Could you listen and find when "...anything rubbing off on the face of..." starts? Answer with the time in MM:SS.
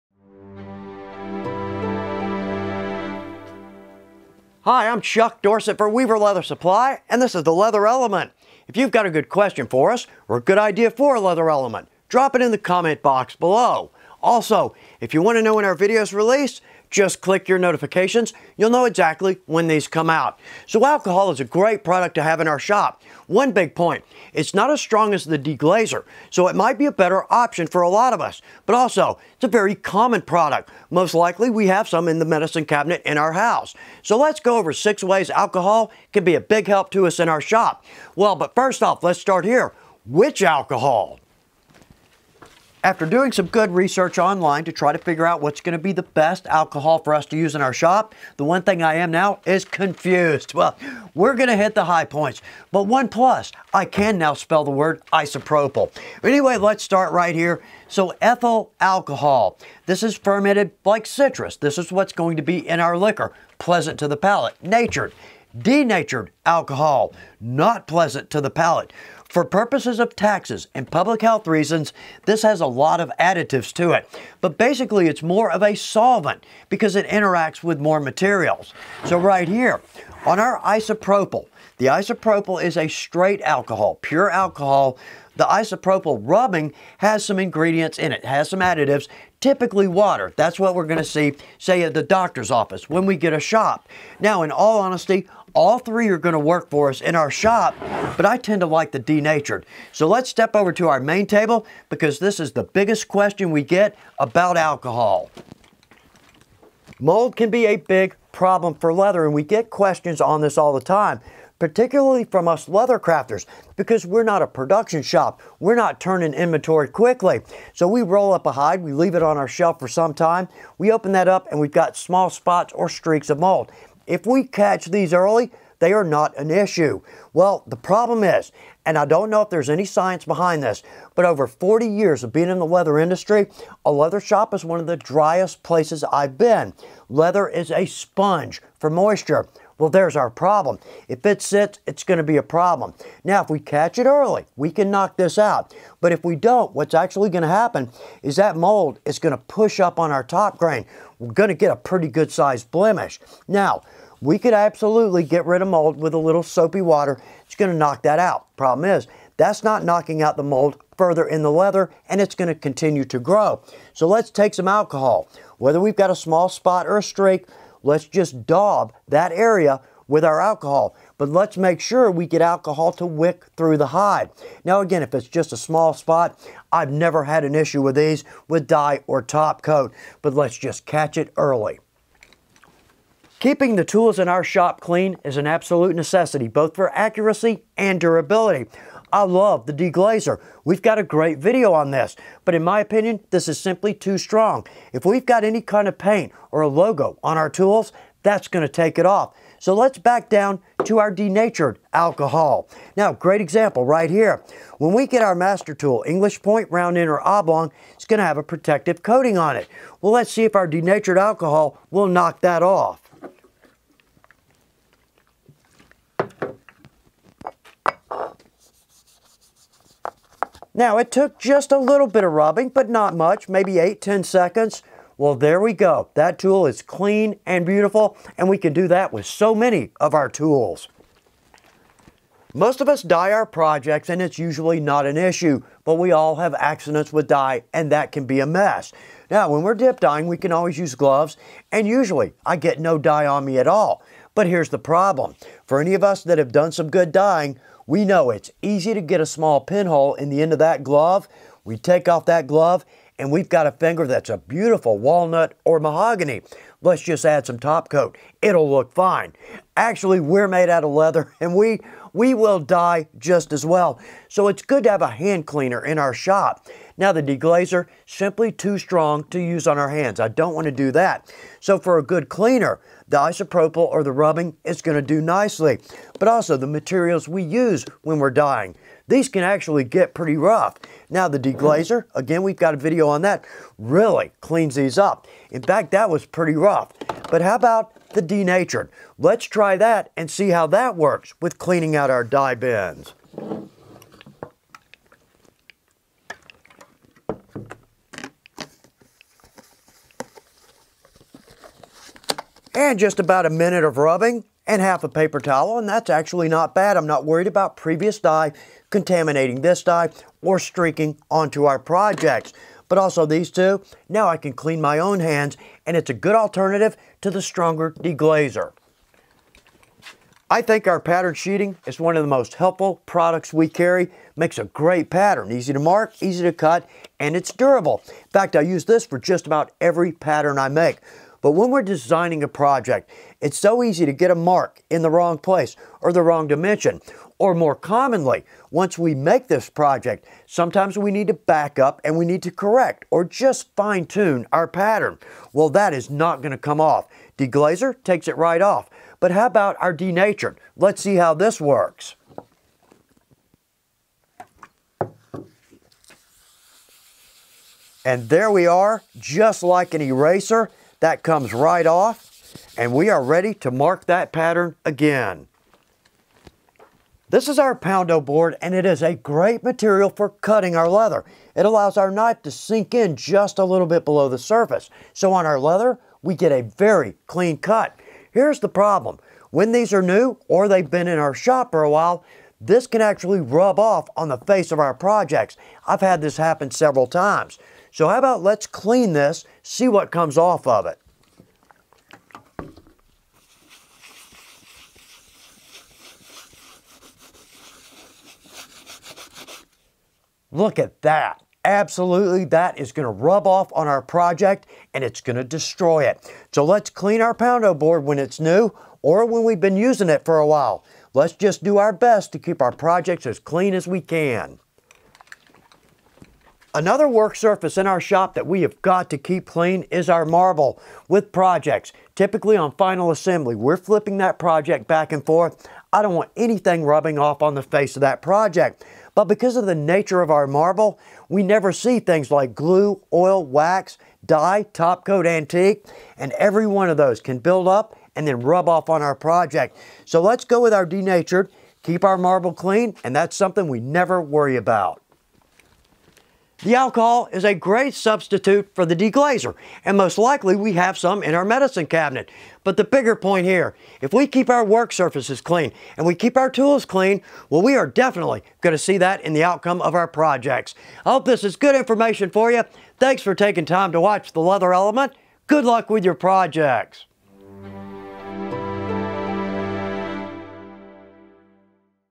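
07:06.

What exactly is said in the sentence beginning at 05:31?
But when we're designing a project, it's so easy to get a mark in the wrong place or the wrong dimension.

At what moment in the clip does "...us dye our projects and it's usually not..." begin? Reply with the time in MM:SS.
03:52.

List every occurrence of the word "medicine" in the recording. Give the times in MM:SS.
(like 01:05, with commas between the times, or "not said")
00:32, 07:31.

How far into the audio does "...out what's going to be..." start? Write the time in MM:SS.
00:45.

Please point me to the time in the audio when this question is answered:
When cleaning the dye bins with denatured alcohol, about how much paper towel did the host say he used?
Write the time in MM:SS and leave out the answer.
05:04.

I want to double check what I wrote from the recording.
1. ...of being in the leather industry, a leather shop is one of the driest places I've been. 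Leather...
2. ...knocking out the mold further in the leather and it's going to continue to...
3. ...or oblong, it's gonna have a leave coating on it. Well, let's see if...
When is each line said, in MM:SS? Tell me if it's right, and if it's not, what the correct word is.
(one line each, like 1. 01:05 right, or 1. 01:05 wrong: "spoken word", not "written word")
1. 02:12 right
2. 02:39 right
3. 03:27 wrong: "protective", not "leave".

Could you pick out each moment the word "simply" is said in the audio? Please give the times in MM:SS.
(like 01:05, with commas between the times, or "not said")
03:13, 04:28.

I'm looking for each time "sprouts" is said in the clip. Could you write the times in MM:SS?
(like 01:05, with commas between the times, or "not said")
not said.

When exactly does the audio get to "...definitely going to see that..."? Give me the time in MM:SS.
07:37.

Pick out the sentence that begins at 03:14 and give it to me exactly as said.
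If we've got any kind of paint or a logo on our tools, that's gonna take it off.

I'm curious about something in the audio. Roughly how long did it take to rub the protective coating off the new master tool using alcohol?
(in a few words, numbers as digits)
8 to 10 seconds.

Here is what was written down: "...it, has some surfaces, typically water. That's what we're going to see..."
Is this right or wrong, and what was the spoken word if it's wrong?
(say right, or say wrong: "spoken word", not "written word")
wrong: "additives", not "surfaces".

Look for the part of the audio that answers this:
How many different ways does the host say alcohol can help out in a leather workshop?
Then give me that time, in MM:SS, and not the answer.
00:34.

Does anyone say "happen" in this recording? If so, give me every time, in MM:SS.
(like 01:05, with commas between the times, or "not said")
02:27, 06:26.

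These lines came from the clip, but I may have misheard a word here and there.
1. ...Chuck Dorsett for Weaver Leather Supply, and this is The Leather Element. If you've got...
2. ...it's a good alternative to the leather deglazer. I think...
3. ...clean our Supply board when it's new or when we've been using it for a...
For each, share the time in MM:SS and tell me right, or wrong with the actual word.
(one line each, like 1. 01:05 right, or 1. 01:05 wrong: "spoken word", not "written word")
1. 00:05 right
2. 05:15 wrong: "stronger", not "leather"
3. 06:46 wrong: "Poundo", not "Supply".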